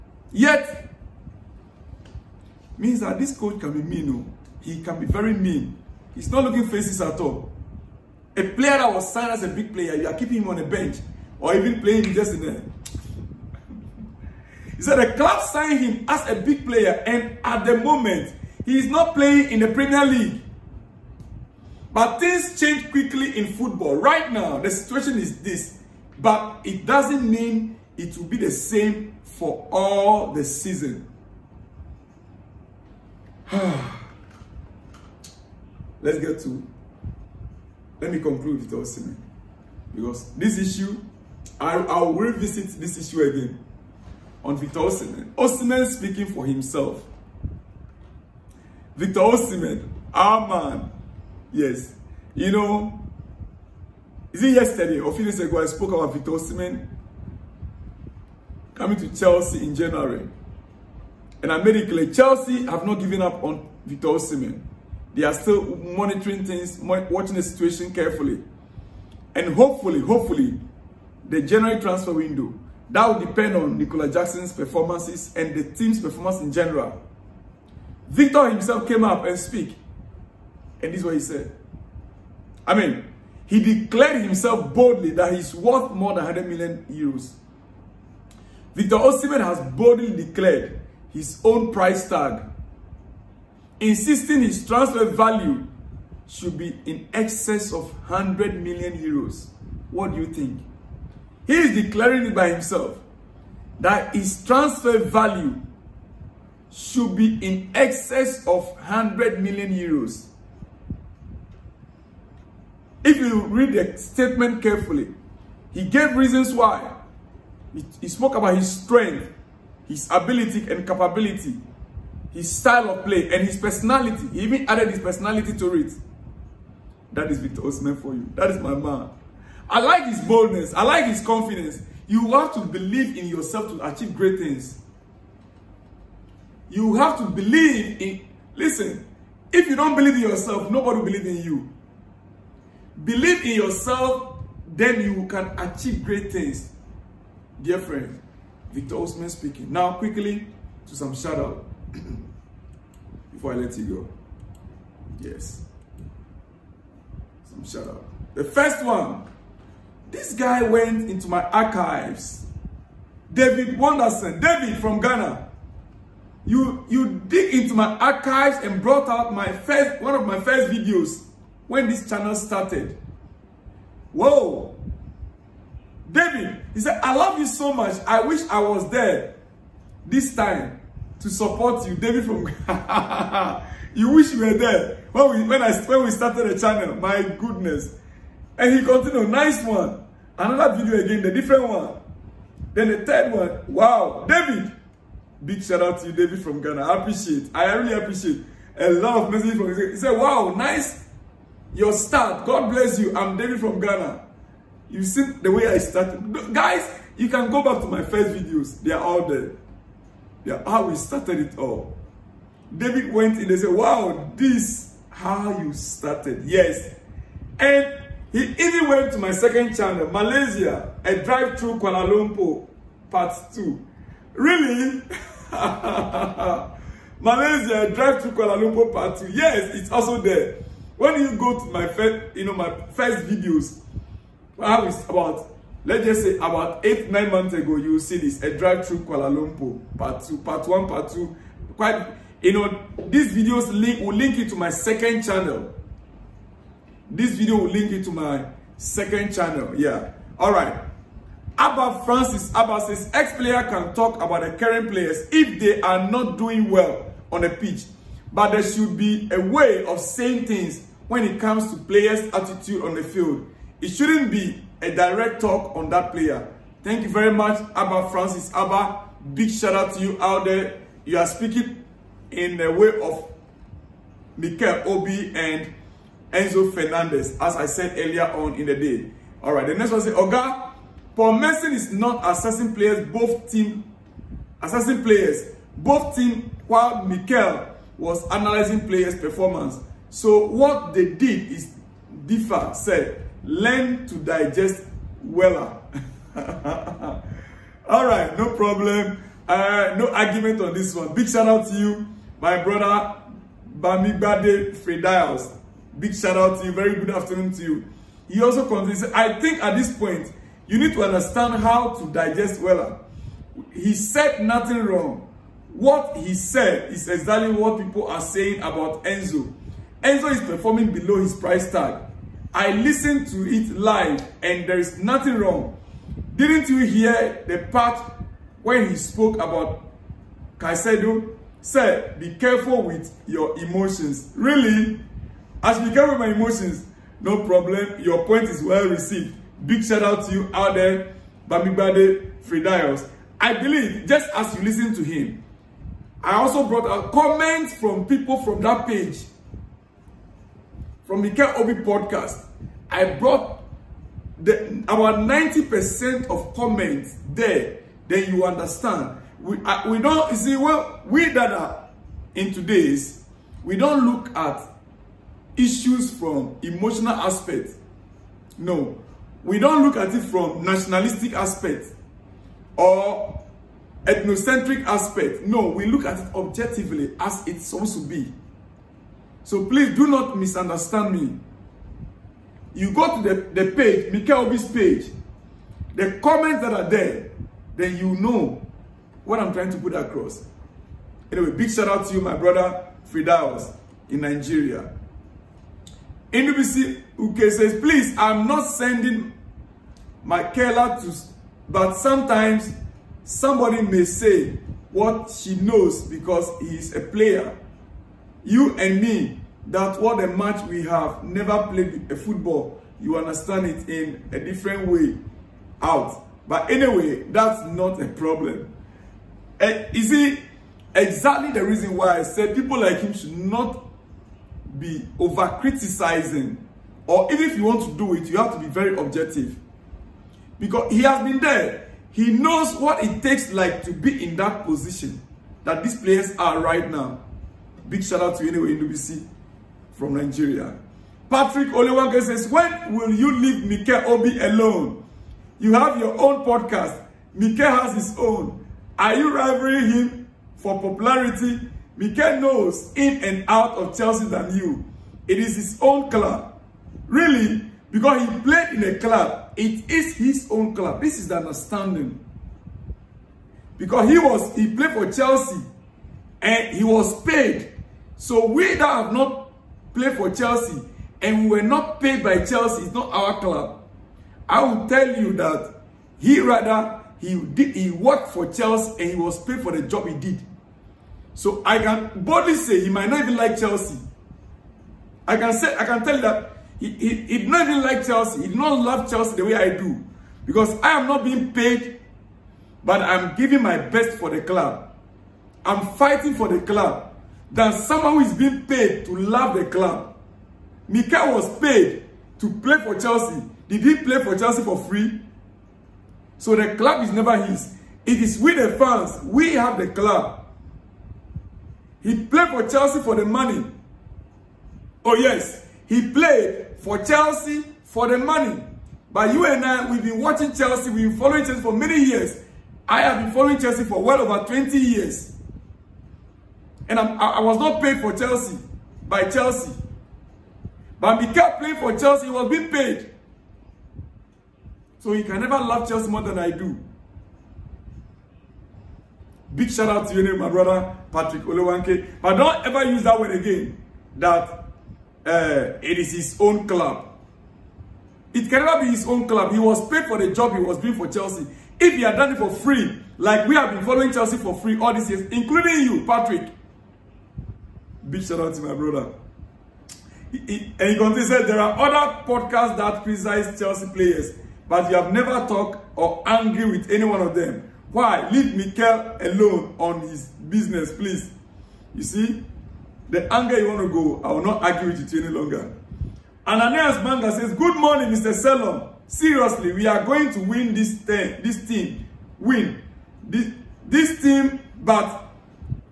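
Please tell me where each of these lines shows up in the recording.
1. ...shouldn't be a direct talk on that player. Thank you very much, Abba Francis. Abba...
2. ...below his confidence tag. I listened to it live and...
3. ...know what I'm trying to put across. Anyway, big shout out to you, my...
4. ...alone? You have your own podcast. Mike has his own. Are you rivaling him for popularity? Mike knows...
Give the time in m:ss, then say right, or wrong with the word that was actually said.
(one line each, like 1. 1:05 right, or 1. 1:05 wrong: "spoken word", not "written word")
1. 4:23 right
2. 5:20 wrong: "price", not "confidence"
3. 6:28 right
4. 7:24 right.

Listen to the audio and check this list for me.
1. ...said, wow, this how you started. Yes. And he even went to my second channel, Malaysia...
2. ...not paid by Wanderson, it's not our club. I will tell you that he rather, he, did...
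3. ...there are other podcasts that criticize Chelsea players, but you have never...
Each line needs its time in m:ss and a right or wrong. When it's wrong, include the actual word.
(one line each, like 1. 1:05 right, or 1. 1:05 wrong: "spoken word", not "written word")
1. 3:33 right
2. 7:51 wrong: "Chelsea", not "Wanderson"
3. 9:21 right.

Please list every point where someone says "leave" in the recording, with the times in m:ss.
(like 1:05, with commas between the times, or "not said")
7:23, 9:28.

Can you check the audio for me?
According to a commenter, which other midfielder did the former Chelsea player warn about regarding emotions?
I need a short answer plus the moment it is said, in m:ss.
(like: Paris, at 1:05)
Caicedo, at 5:30.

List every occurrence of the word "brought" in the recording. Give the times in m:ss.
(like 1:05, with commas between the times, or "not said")
2:48, 5:46, 5:53.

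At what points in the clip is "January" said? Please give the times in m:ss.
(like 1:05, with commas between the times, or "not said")
0:59, 1:11.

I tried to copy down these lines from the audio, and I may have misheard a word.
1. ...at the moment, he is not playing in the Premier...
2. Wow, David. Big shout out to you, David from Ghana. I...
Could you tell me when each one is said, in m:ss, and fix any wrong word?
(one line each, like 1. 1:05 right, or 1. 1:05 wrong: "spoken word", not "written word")
1. 0:17 right
2. 3:13 right.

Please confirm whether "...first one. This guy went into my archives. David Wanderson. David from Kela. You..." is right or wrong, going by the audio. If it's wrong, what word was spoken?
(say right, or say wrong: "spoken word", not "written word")
wrong: "Ghana", not "Kela".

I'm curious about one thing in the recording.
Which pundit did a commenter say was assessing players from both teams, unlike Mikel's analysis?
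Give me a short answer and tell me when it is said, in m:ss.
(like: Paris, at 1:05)
Paul Merson, at 4:41.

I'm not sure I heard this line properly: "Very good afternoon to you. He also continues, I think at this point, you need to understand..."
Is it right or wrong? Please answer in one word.
right.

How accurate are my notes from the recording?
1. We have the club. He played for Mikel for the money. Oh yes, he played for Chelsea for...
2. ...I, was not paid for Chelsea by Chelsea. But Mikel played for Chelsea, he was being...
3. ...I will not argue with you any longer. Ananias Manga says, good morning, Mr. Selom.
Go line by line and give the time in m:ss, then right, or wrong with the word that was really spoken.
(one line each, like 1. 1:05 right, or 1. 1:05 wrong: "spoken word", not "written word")
1. 8:29 wrong: "Chelsea", not "Mikel"
2. 8:47 right
3. 9:34 right.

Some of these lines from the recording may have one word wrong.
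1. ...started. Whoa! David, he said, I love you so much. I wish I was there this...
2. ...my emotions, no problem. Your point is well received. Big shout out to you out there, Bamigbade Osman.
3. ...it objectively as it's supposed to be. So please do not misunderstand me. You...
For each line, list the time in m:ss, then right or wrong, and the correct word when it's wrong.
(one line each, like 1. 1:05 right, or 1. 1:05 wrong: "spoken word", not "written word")
1. 2:52 right
2. 5:36 wrong: "Fridayos", not "Osman"
3. 6:16 right.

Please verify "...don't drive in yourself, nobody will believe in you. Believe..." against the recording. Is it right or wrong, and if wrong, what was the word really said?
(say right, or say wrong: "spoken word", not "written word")
wrong: "believe", not "drive".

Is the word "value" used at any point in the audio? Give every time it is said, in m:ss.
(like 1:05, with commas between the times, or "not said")
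1:35, 1:44.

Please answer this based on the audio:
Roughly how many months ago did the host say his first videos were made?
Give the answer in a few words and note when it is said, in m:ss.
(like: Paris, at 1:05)
8 or 9 months, at 3:56.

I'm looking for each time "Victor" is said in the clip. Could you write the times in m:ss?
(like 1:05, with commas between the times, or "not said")
0:44, 0:48, 0:56, 1:03, 1:18, 1:28, 2:07, 2:28.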